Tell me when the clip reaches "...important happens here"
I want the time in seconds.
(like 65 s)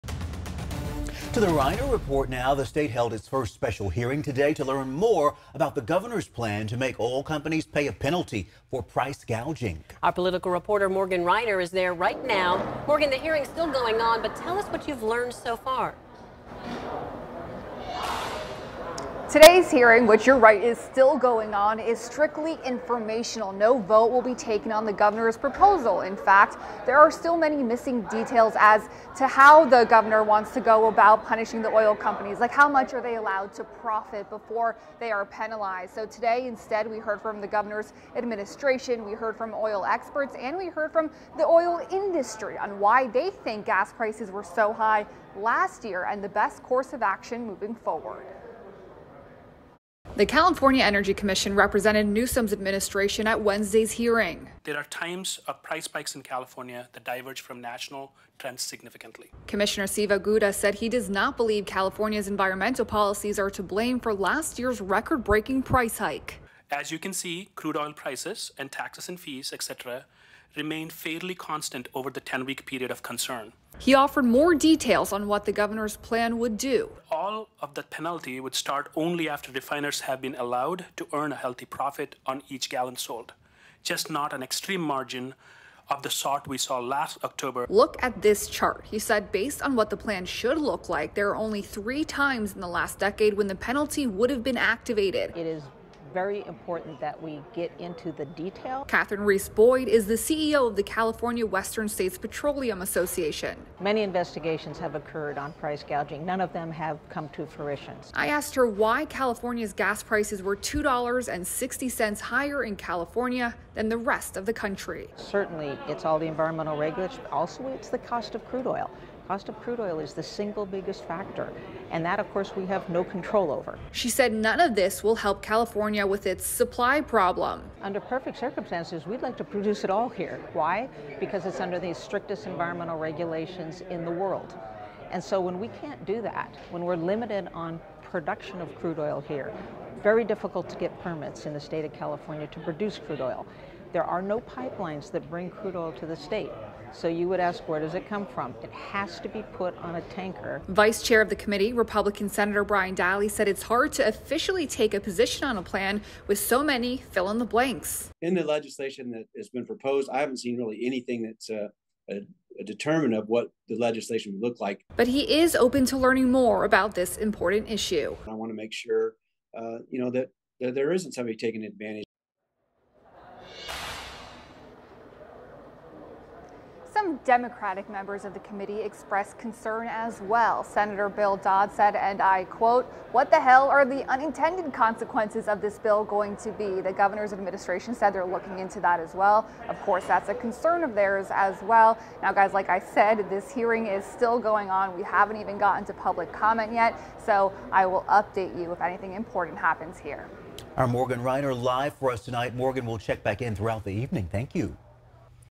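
199 s.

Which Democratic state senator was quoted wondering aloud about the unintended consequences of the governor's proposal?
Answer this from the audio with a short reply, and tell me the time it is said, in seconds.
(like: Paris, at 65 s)
Bill Dodd, at 181 s.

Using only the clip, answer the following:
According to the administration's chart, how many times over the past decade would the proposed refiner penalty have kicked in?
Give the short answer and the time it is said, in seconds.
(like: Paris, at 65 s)
3, at 91 s.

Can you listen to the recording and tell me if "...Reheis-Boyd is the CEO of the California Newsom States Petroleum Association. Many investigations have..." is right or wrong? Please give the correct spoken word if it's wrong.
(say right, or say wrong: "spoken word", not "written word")
wrong: "Western", not "Newsom".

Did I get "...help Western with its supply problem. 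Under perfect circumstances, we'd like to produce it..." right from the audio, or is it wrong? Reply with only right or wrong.
wrong.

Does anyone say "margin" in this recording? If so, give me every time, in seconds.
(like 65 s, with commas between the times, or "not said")
84 s.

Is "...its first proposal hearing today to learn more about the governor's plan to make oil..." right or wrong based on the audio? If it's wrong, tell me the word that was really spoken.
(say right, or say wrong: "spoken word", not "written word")
wrong: "special", not "proposal".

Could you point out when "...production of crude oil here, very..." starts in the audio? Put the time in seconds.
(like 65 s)
138 s.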